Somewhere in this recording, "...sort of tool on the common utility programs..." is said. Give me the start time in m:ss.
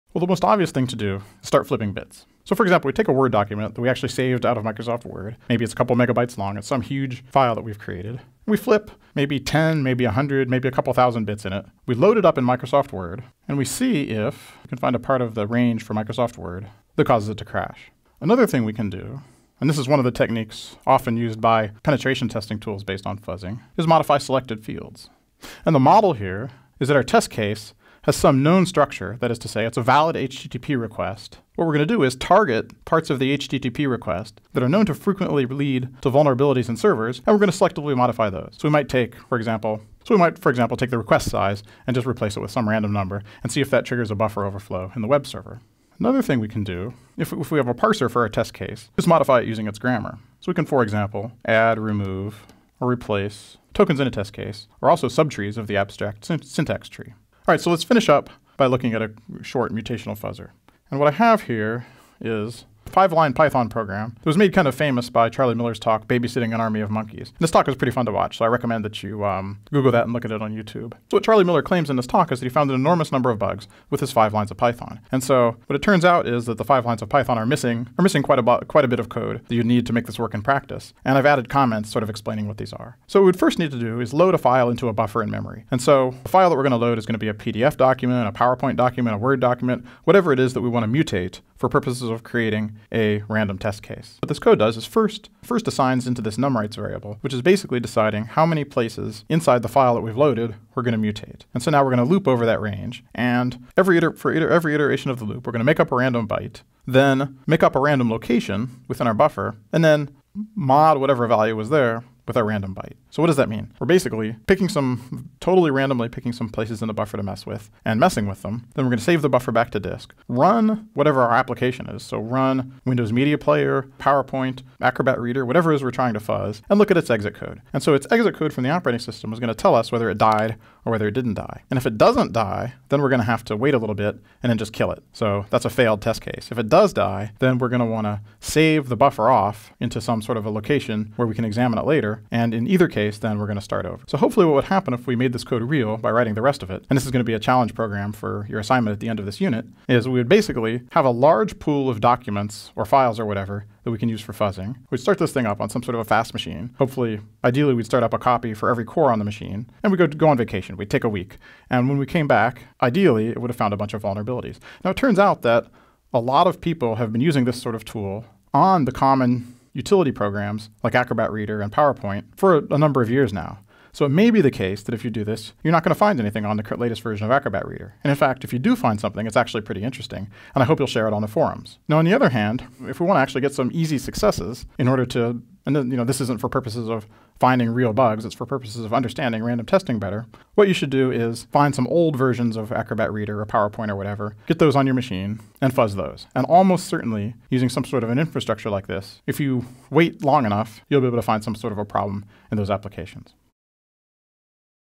2:47.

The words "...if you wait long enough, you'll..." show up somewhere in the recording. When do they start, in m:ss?
3:19.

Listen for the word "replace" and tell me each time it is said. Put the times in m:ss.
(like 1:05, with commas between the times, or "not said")
0:42, 0:52.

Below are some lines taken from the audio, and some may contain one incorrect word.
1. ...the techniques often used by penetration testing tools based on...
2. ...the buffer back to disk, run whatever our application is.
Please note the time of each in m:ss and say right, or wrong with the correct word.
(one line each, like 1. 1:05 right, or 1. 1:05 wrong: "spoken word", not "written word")
1. 0:20 right
2. 1:59 right.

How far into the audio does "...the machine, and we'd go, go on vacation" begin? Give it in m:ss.
2:39.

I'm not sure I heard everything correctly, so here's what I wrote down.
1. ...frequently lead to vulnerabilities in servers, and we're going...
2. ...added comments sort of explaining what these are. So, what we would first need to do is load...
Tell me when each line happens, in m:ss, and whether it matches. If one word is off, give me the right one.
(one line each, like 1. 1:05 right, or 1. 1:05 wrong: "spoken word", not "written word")
1. 0:34 right
2. 1:21 right.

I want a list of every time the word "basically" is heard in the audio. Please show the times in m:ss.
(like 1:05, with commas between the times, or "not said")
1:37, 1:53, 2:30.